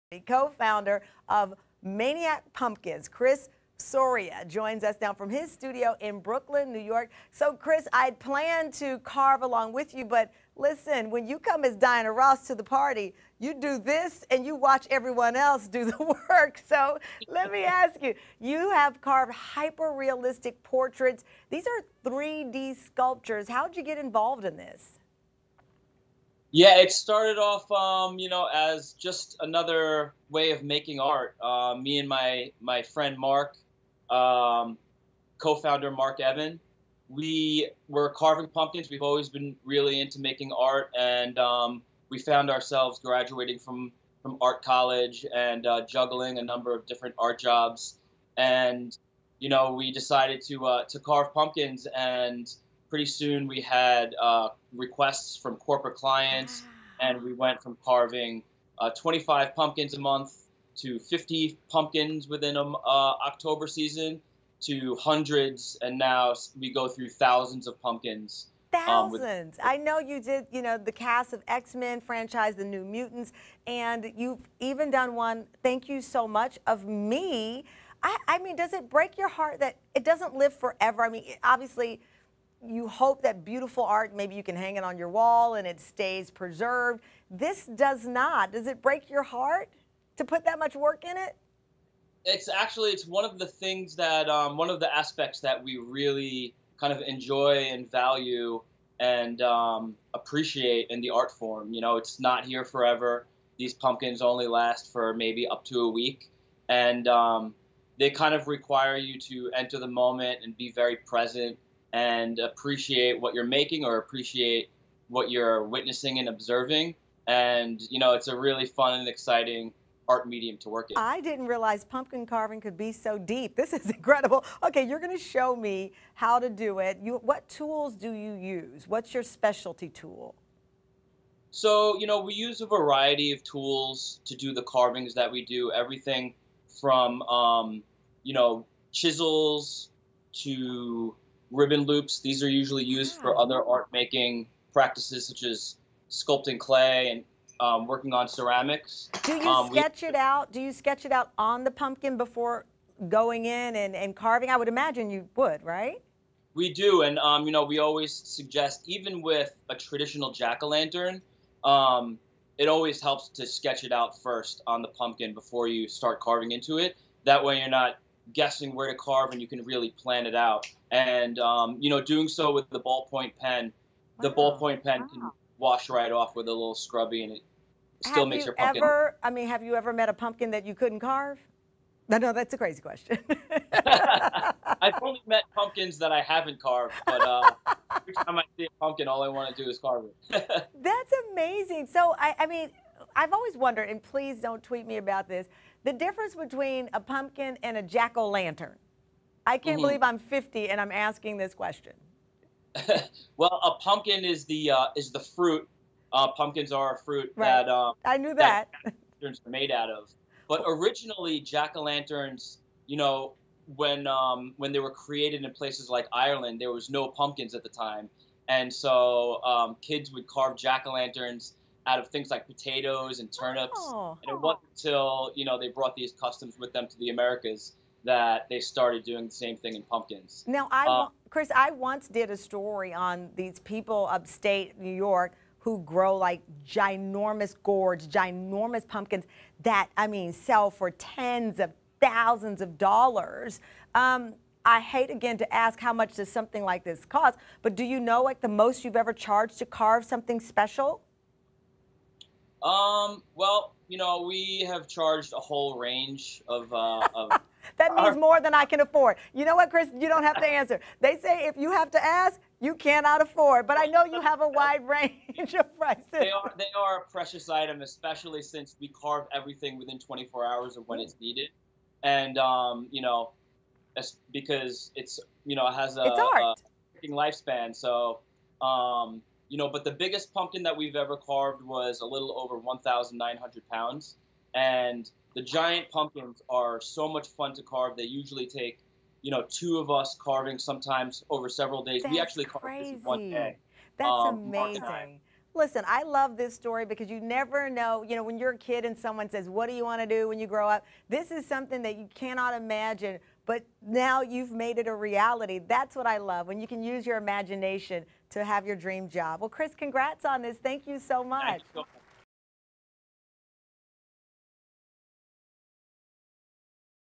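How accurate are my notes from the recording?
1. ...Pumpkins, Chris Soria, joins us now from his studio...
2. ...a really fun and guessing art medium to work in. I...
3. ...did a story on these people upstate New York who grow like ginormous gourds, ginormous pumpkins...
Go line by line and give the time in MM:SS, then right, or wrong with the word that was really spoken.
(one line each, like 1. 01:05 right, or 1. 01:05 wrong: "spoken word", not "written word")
1. 00:02 right
2. 01:58 wrong: "exciting", not "guessing"
3. 03:52 right.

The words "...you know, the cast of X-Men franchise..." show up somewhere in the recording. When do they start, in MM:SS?
01:10.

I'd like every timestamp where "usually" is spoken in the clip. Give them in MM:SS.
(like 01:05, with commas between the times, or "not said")
02:22, 04:48.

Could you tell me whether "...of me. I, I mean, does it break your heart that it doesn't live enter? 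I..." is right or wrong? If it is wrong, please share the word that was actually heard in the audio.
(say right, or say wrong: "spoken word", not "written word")
wrong: "forever", not "enter".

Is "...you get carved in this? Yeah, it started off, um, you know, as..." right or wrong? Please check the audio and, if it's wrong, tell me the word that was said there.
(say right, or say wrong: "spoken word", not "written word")
wrong: "involved", not "carved".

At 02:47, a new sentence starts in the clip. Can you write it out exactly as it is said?
That way, you're not guessing where to carve and you can really plan it out.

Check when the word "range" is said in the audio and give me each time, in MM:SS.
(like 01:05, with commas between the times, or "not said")
04:15, 04:24.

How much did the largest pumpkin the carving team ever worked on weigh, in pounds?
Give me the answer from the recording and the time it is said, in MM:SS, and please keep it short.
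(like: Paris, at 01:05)
Over 1,900 pounds, at 04:41.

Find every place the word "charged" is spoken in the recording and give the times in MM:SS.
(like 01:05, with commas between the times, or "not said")
04:09, 04:14.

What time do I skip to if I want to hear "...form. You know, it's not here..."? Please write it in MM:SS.
01:41.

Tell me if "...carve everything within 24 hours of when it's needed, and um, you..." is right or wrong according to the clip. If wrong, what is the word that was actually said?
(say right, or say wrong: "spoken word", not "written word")
right.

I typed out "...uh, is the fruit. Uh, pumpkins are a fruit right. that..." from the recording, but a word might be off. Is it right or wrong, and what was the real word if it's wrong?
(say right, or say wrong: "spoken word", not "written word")
right.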